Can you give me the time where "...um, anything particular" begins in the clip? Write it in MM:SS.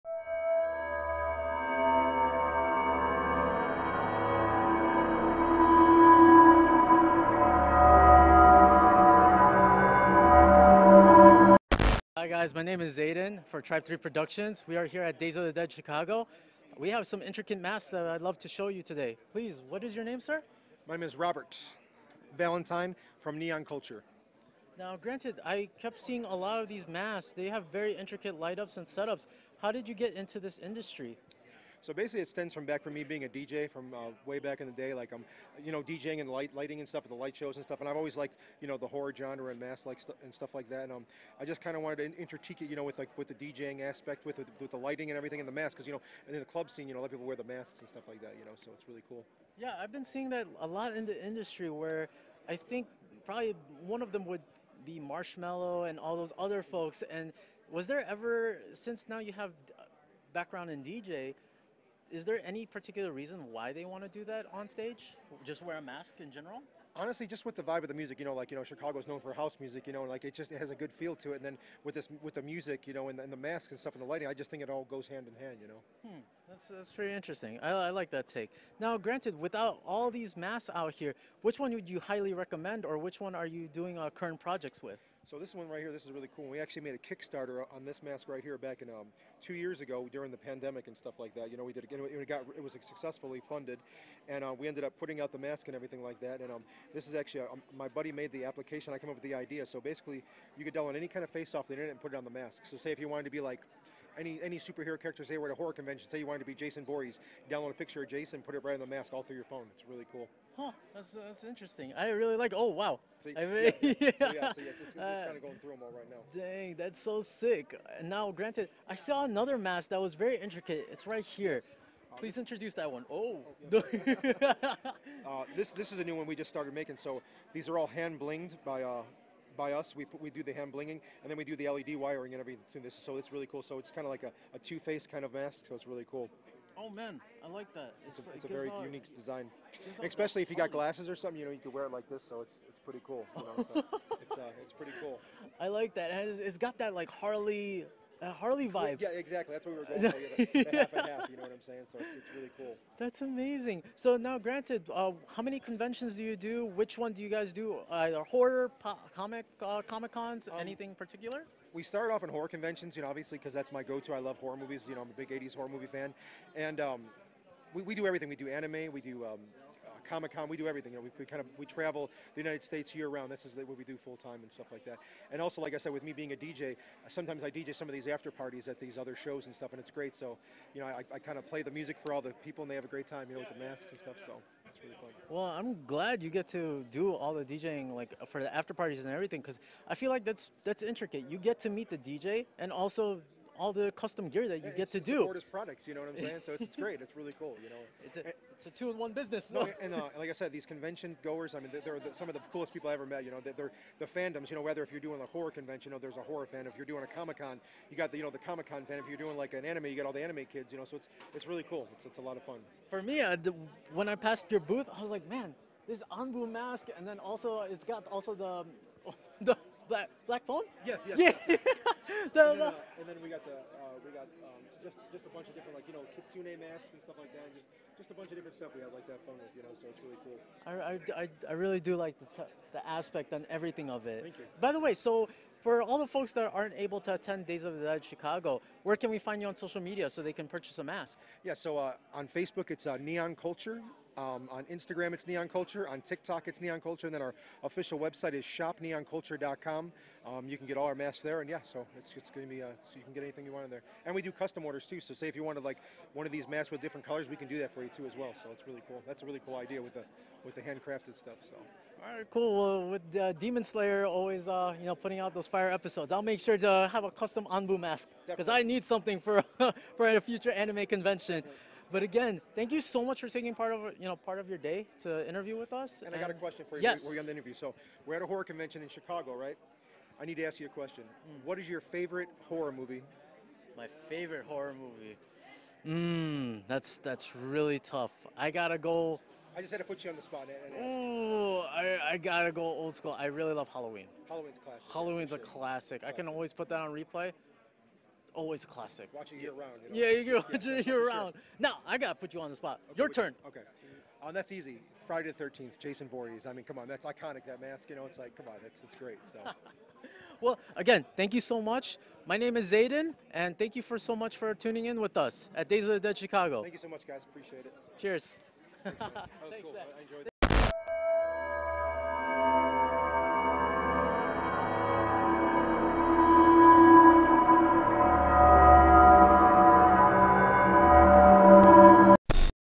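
02:40.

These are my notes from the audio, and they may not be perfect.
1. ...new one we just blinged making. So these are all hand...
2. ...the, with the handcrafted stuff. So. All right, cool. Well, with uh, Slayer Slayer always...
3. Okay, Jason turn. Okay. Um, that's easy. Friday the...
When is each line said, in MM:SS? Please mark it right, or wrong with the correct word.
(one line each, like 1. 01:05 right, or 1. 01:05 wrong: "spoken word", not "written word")
1. 02:06 wrong: "started", not "blinged"
2. 04:19 wrong: "Demon", not "Slayer"
3. 05:02 wrong: "Your", not "Jason".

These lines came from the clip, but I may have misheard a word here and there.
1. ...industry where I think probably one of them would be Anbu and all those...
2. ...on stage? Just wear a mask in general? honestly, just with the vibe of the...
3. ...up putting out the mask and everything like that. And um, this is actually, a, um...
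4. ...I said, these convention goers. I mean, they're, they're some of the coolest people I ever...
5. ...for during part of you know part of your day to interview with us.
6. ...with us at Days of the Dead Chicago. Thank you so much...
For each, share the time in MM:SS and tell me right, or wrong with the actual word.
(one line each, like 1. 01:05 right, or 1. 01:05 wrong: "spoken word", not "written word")
1. 00:51 wrong: "Marshmello", not "Anbu"
2. 01:04 right
3. 01:34 right
4. 03:20 right
5. 04:33 wrong: "taking", not "during"
6. 05:15 right.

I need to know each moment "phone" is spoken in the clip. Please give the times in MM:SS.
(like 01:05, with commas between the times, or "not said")
01:49, 03:40, 03:49.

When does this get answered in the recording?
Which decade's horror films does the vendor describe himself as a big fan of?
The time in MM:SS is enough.
02:45.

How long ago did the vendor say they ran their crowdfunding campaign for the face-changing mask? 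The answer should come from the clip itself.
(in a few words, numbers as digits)
2 years ago.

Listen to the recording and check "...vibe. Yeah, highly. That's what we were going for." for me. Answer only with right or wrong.
wrong.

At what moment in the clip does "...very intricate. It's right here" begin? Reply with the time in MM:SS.
02:00.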